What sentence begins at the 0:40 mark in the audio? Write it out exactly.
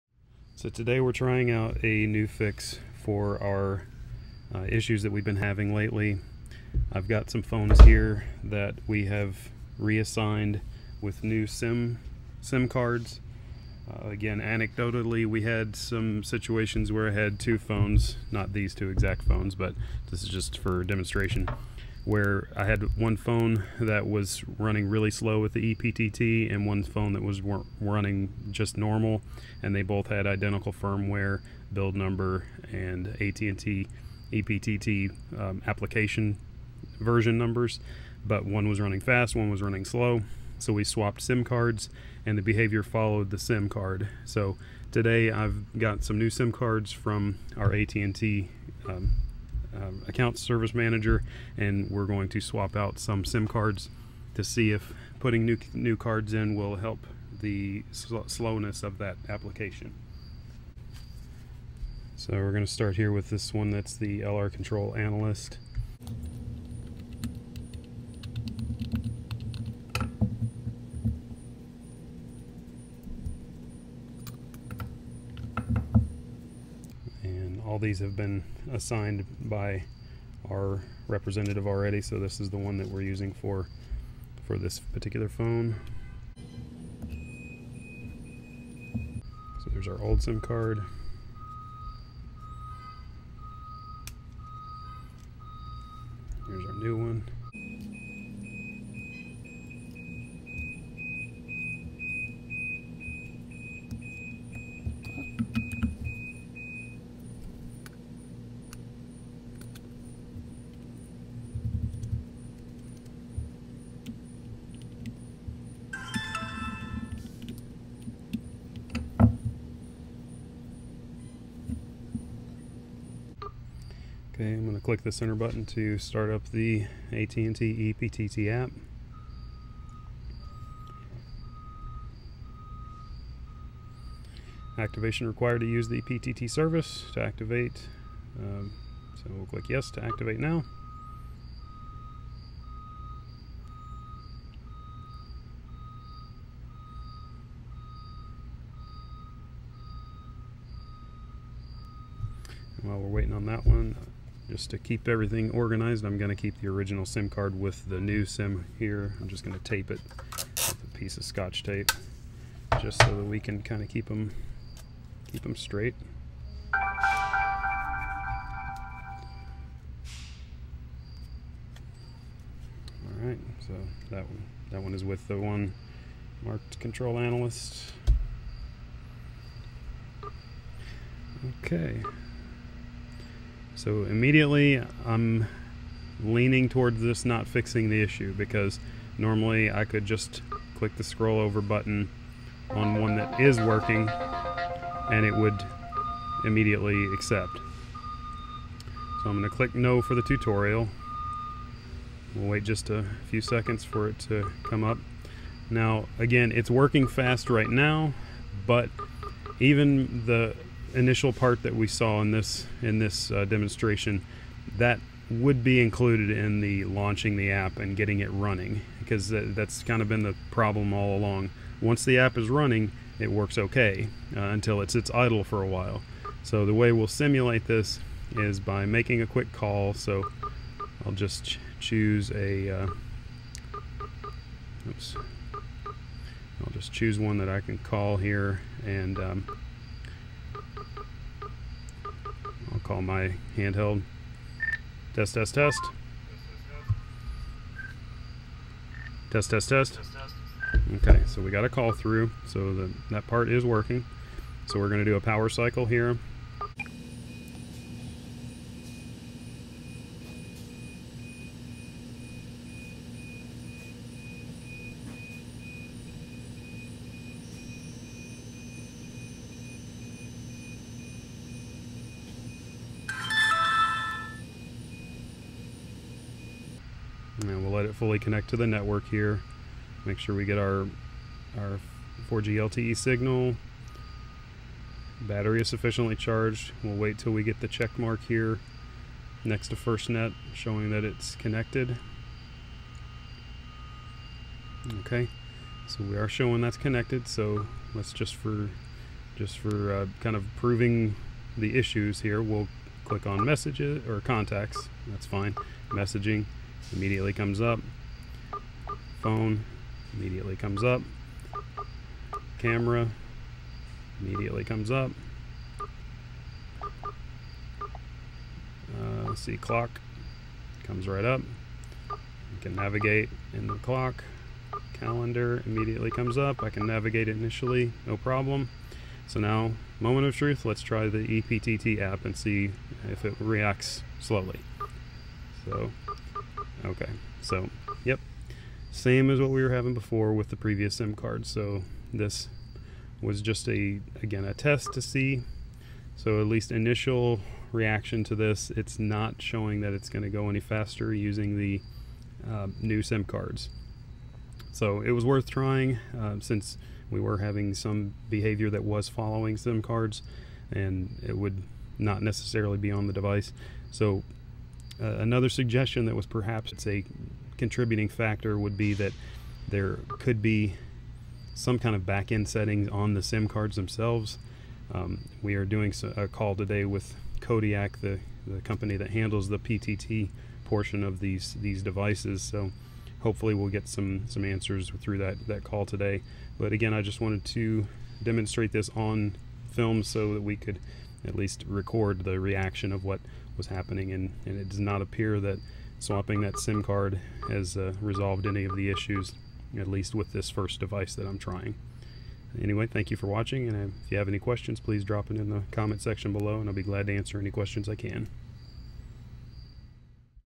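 So we swapped SIM cards, and the behavior followed the SIM card.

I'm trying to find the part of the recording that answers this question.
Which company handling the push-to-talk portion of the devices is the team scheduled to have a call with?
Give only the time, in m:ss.
6:17.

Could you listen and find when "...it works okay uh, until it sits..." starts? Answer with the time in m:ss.
3:43.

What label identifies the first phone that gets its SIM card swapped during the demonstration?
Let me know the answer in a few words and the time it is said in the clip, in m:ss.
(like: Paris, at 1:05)
LR Control Analyst, at 1:04.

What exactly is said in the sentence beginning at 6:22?
So hopefully we'll get some some answers through that that call today.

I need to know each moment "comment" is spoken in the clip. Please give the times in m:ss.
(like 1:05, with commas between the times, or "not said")
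6:45.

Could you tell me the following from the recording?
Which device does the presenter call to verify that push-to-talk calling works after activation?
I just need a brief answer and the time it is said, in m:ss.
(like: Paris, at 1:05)
handheld, at 4:03.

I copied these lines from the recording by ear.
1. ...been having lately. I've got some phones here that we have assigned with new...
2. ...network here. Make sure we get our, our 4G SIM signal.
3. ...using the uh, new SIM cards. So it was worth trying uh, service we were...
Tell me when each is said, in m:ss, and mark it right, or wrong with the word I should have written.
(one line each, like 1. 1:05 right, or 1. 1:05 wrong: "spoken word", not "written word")
1. 0:05 wrong: "reassigned", not "assigned"
2. 4:38 wrong: "LTE", not "SIM"
3. 5:51 wrong: "since", not "service".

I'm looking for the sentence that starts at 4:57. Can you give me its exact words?
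So let's just for just for uh, kind of proving the issues here, we'll click on messages or contacts.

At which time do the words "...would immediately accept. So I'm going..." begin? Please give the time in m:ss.
3:15.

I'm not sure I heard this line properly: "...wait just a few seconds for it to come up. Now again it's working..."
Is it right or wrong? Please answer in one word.
right.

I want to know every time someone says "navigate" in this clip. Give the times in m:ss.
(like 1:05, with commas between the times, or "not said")
5:22, 5:26.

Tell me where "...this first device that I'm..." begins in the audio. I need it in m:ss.
6:40.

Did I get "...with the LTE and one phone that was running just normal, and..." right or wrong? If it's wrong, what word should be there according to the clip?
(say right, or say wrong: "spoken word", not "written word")
wrong: "EPTT", not "LTE".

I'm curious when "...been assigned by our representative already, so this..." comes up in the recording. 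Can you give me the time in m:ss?
1:18.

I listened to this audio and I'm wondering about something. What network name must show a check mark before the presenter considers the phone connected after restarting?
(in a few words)
FirstNet.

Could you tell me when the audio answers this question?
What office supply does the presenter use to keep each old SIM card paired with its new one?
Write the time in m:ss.
2:41.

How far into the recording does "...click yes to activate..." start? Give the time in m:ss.
2:19.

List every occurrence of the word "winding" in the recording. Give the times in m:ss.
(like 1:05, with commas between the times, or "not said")
not said.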